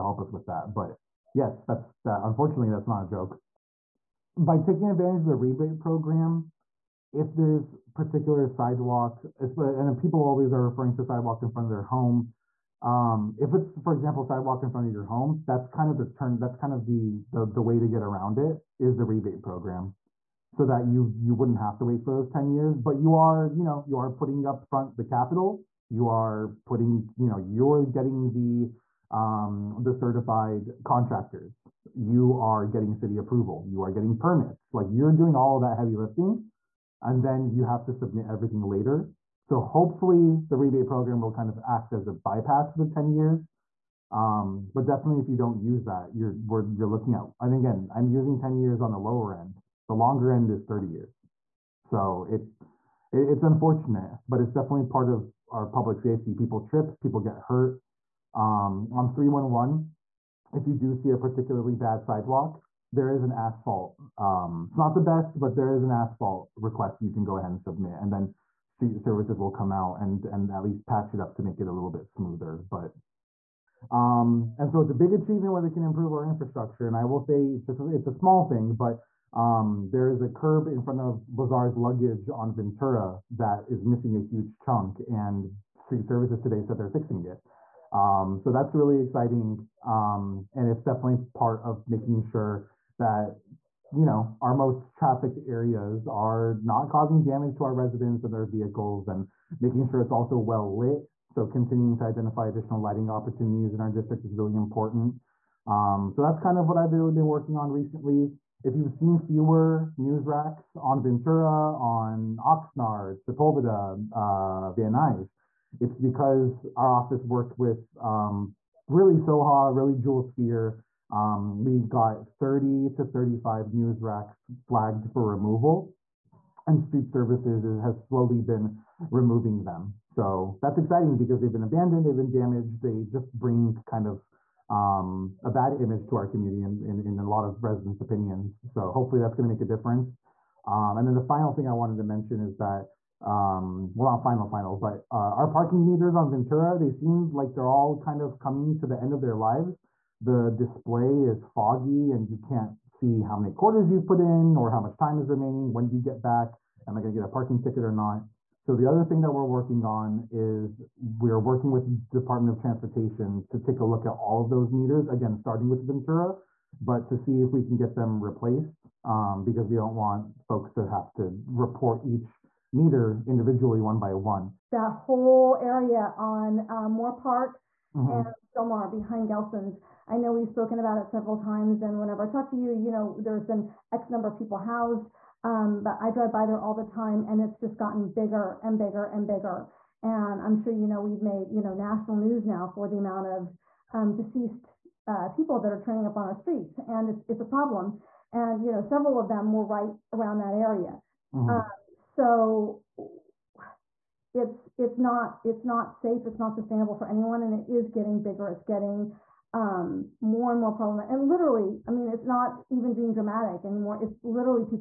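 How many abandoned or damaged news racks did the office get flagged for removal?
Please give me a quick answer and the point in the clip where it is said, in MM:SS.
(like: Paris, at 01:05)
30 to 35, at 02:02.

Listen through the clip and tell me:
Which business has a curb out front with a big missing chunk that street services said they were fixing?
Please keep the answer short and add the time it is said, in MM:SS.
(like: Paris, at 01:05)
Lazar's luggage, at 01:21.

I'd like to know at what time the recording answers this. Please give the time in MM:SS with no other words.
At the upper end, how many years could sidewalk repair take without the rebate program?
00:50.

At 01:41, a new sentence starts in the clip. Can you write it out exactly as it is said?
So continuing to identify additional lighting opportunities in our district is really important.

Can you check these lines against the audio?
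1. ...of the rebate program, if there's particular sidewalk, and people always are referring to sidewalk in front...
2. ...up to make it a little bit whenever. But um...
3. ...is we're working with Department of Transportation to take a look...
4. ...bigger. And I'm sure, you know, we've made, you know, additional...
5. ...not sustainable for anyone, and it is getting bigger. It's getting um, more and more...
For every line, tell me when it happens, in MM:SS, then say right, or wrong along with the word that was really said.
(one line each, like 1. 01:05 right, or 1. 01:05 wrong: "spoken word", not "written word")
1. 00:05 right
2. 01:11 wrong: "smoother", not "whenever"
3. 02:40 right
4. 03:09 wrong: "national", not "additional"
5. 03:26 right.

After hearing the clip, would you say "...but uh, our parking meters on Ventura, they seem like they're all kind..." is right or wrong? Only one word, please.
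right.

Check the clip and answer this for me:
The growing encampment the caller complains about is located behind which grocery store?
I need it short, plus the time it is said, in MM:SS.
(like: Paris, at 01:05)
Gelson's, at 02:59.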